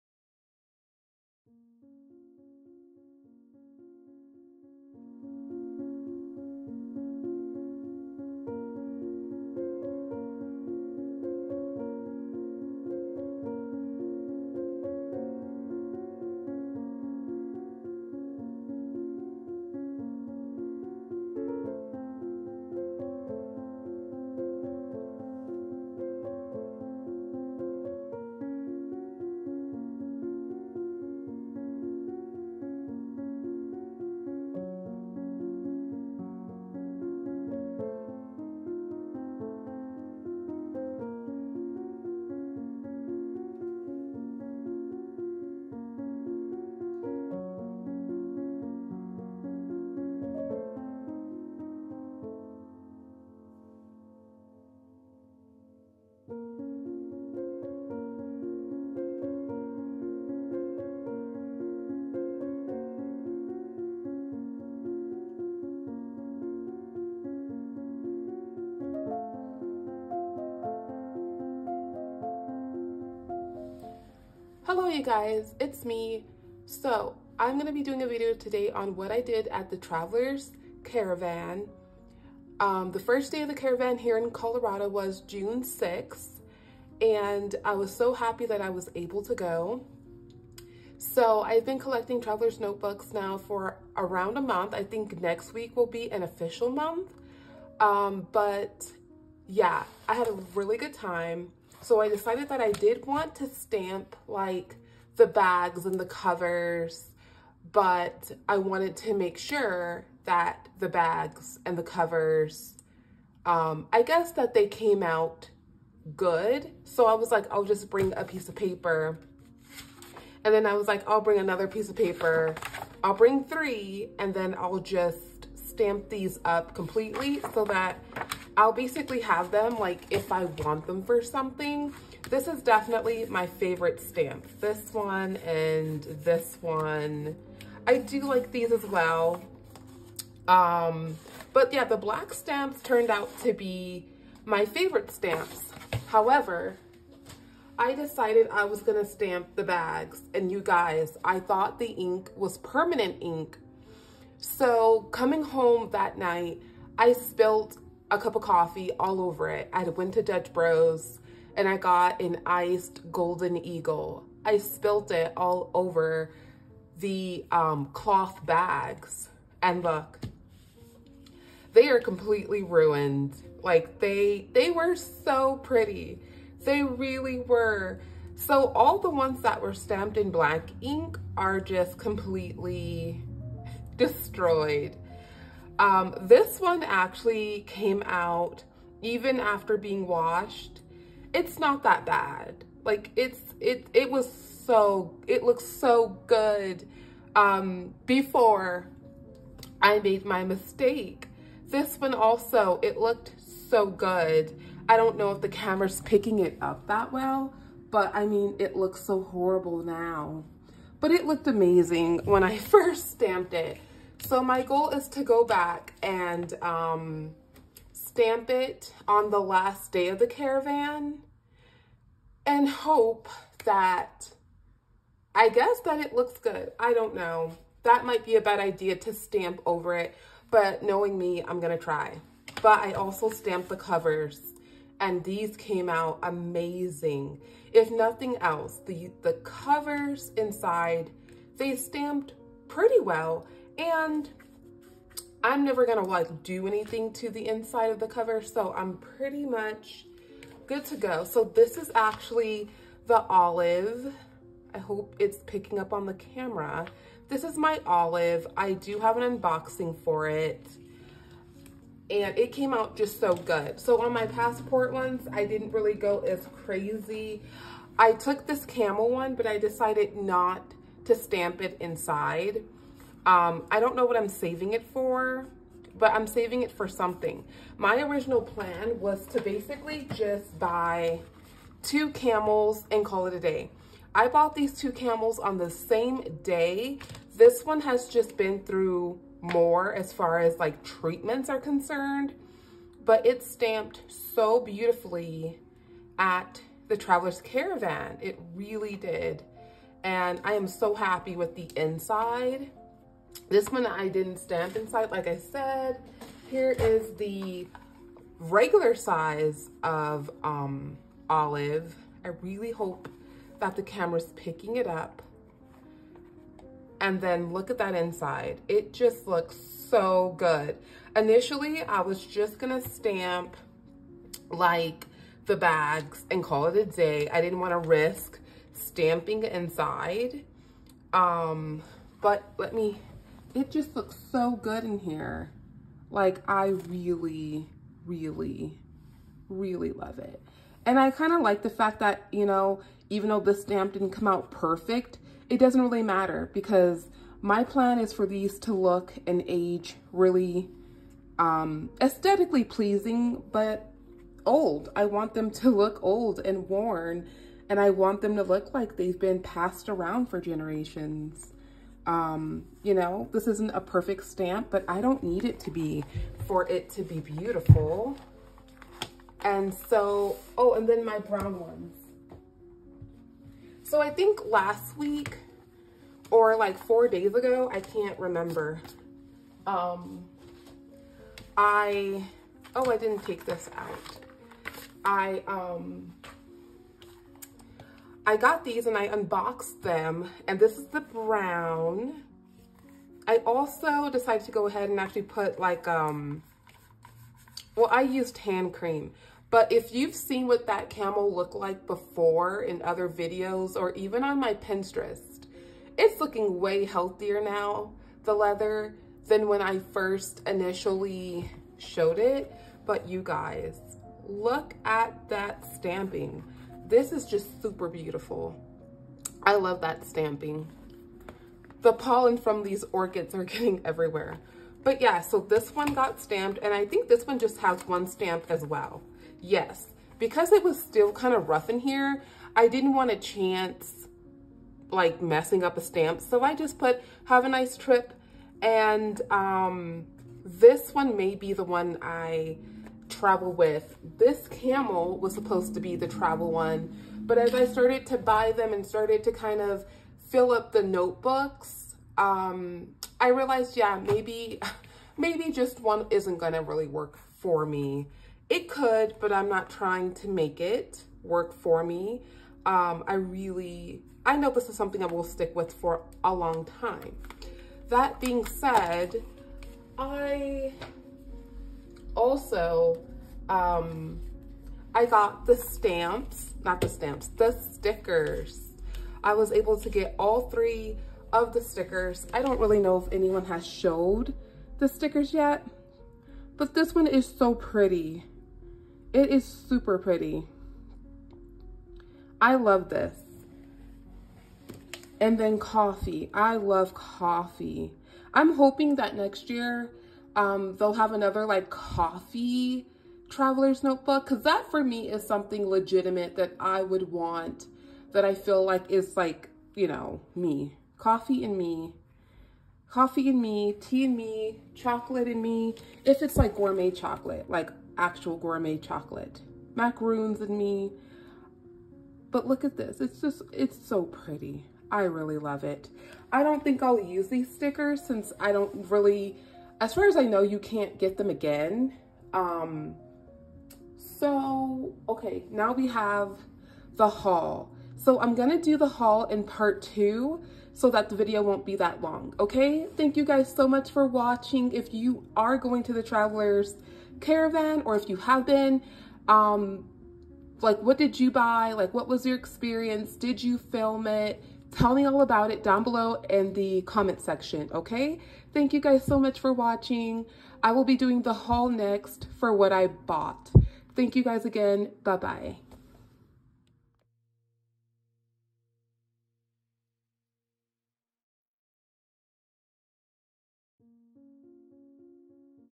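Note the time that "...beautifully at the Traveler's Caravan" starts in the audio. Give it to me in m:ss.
4:54.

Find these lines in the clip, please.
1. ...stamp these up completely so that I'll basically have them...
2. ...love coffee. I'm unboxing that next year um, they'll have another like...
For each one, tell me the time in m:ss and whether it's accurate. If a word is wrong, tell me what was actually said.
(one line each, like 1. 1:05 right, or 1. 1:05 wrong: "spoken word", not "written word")
1. 2:05 right
2. 8:16 wrong: "hoping", not "unboxing".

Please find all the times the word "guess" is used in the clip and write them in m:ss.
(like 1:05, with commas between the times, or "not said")
1:54, 3:45.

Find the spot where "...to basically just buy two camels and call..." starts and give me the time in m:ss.
4:39.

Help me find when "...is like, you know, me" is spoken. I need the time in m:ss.
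8:28.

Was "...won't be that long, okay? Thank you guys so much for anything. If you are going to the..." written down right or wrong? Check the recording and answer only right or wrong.
wrong.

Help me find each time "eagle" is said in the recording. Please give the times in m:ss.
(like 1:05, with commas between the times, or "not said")
2:43.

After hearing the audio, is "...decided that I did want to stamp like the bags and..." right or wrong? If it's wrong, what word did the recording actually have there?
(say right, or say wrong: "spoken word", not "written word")
right.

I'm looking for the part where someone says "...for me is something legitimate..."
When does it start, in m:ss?
8:24.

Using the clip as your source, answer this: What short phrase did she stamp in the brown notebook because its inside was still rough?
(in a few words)
have a nice trip.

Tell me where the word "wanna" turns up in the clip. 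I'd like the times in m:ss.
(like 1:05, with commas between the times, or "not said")
5:27.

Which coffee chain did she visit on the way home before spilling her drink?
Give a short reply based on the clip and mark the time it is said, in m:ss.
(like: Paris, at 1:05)
Dutch Bros, at 2:40.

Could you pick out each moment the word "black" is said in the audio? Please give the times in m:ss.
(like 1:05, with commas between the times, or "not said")
2:21, 3:00.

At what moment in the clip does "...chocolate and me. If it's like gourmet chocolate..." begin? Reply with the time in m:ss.
8:34.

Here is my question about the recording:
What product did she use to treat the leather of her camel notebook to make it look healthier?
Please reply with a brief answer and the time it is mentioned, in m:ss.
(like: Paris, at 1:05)
hand cream, at 6:38.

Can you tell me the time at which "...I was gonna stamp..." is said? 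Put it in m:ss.
2:28.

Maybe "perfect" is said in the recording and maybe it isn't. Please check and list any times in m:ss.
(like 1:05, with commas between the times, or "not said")
5:44, 6:03.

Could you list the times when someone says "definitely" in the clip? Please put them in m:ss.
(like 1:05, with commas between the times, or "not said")
2:12.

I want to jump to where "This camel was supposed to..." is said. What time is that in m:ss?
7:24.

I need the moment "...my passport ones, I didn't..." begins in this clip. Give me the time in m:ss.
4:24.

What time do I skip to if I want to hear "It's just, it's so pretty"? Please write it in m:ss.
8:42.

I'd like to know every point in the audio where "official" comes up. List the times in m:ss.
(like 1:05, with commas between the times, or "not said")
1:36.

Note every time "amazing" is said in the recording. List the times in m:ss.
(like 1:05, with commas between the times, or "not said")
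3:31, 3:56.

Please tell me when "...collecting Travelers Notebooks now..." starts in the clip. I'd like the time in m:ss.
1:31.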